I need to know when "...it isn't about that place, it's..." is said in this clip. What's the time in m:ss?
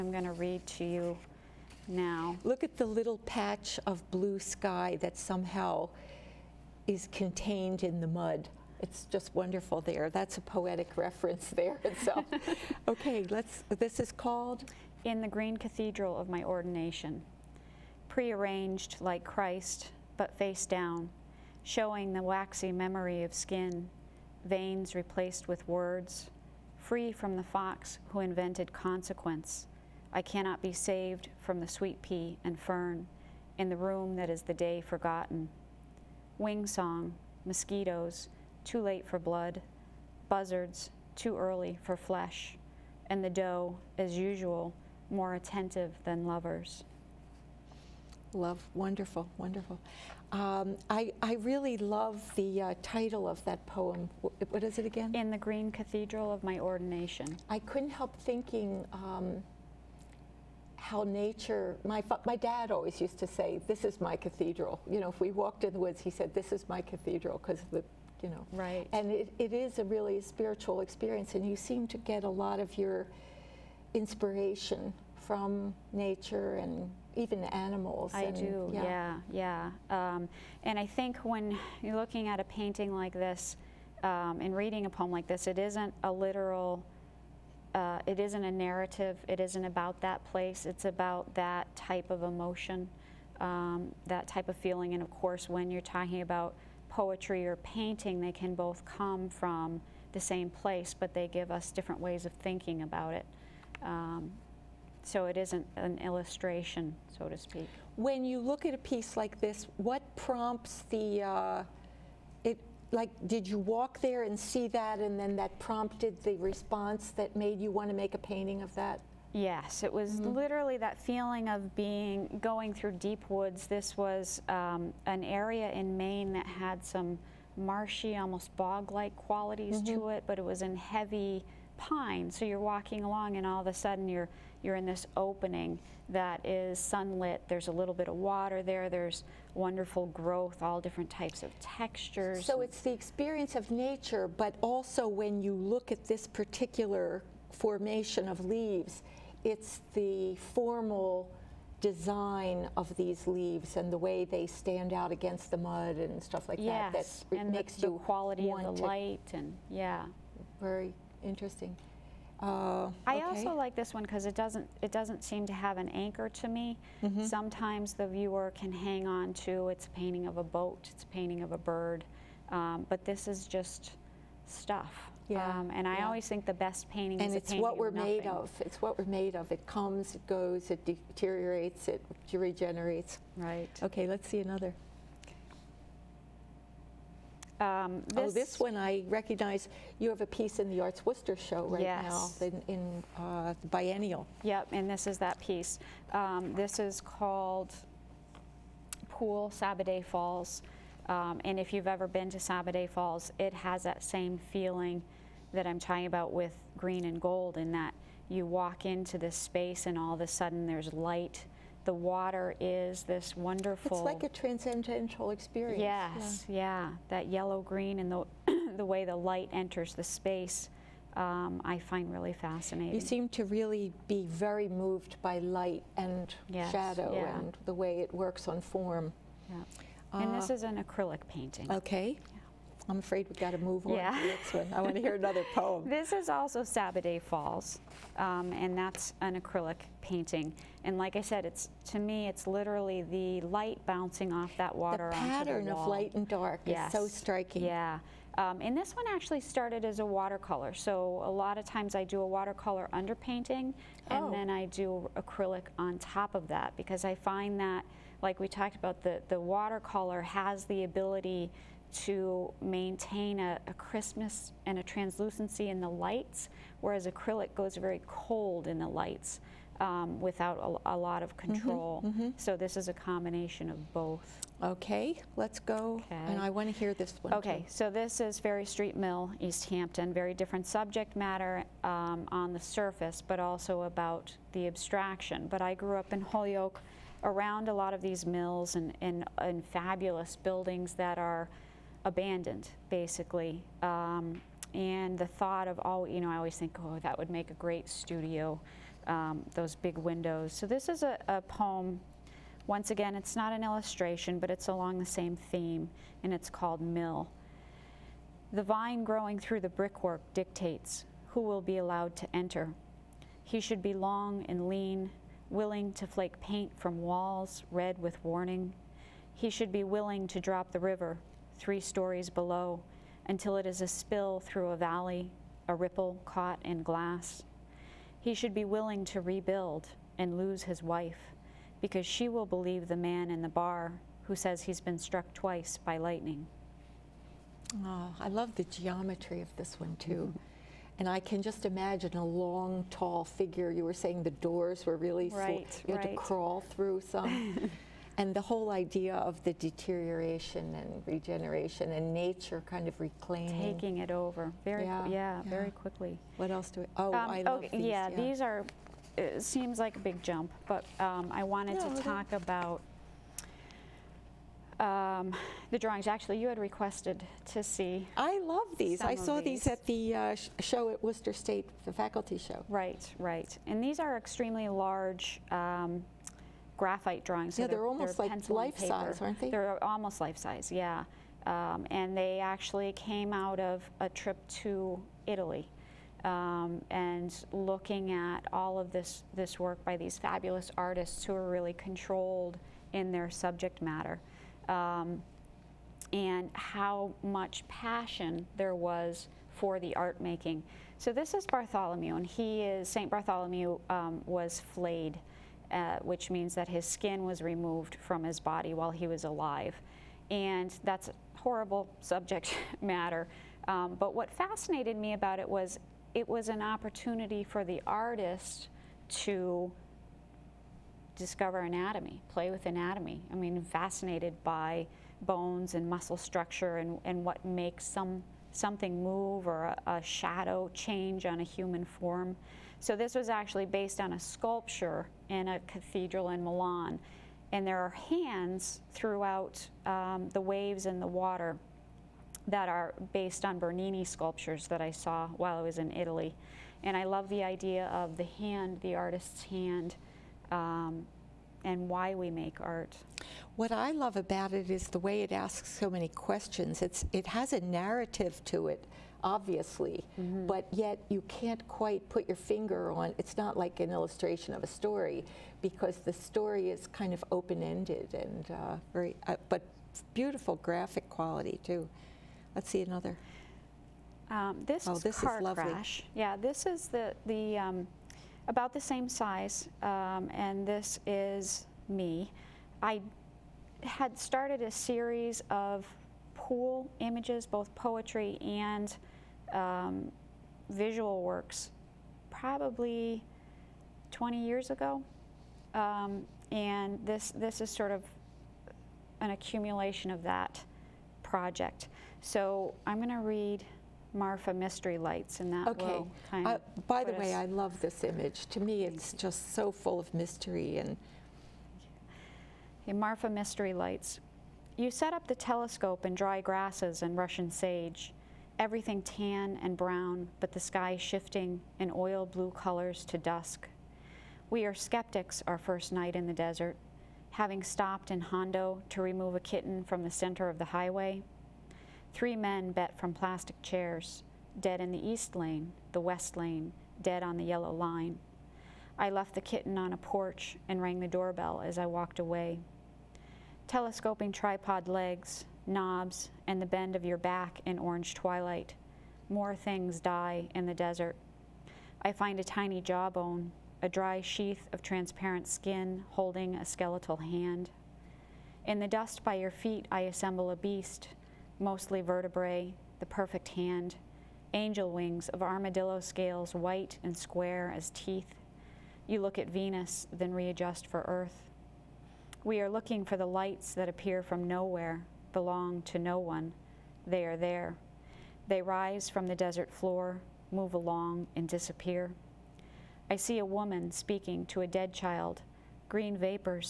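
1:29.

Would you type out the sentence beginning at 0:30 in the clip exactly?
I cannot be saved from the sweet pea and fern in the room that is the day forgotten.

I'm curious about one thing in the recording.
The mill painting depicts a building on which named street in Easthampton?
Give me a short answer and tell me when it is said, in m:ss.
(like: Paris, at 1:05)
Ferry Street, at 4:38.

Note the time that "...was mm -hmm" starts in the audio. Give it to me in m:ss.
1:59.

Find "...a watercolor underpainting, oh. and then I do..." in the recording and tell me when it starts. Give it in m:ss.
4:12.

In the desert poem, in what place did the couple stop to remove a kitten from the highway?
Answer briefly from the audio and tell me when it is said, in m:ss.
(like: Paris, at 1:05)
Hondo, at 8:48.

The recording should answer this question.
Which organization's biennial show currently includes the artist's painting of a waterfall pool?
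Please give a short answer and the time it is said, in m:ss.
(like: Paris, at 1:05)
ArtsWorcester, at 3:10.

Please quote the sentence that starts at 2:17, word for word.
There's a little bit of water there.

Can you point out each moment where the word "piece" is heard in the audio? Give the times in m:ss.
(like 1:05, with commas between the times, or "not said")
1:48, 3:10, 3:15.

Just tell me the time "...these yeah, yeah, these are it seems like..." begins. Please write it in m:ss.
5:57.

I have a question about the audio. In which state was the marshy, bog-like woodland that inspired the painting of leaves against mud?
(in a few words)
Maine.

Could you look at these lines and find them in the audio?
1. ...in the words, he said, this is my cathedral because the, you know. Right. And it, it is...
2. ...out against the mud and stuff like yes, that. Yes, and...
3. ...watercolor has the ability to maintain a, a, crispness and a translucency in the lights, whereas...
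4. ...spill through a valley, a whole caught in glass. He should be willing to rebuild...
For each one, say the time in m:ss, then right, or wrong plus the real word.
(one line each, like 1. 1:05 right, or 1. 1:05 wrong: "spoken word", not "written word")
1. 1:05 wrong: "woods", not "words"
2. 2:34 right
3. 4:19 right
4. 5:23 wrong: "ripple", not "whole".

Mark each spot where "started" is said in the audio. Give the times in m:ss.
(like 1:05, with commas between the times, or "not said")
4:09, 8:04.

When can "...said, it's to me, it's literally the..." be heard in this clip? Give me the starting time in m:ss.
4:01.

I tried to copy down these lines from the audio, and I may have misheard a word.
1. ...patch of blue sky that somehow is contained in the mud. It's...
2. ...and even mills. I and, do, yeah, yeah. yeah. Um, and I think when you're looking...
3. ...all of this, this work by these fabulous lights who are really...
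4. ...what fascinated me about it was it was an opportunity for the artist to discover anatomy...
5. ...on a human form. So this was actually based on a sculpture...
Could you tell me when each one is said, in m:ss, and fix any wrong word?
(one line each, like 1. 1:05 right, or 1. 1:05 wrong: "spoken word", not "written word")
1. 0:03 right
2. 1:16 wrong: "animals", not "mills"
3. 6:28 wrong: "artists", not "lights"
4. 6:54 right
5. 7:11 right.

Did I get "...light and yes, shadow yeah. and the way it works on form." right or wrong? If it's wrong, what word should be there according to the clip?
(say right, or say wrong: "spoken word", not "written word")
right.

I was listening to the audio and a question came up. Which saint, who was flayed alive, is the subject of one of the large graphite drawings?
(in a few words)
St. Bartholomew.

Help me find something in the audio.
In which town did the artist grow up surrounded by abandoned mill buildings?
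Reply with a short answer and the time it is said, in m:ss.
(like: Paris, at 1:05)
Holyoke, at 4:46.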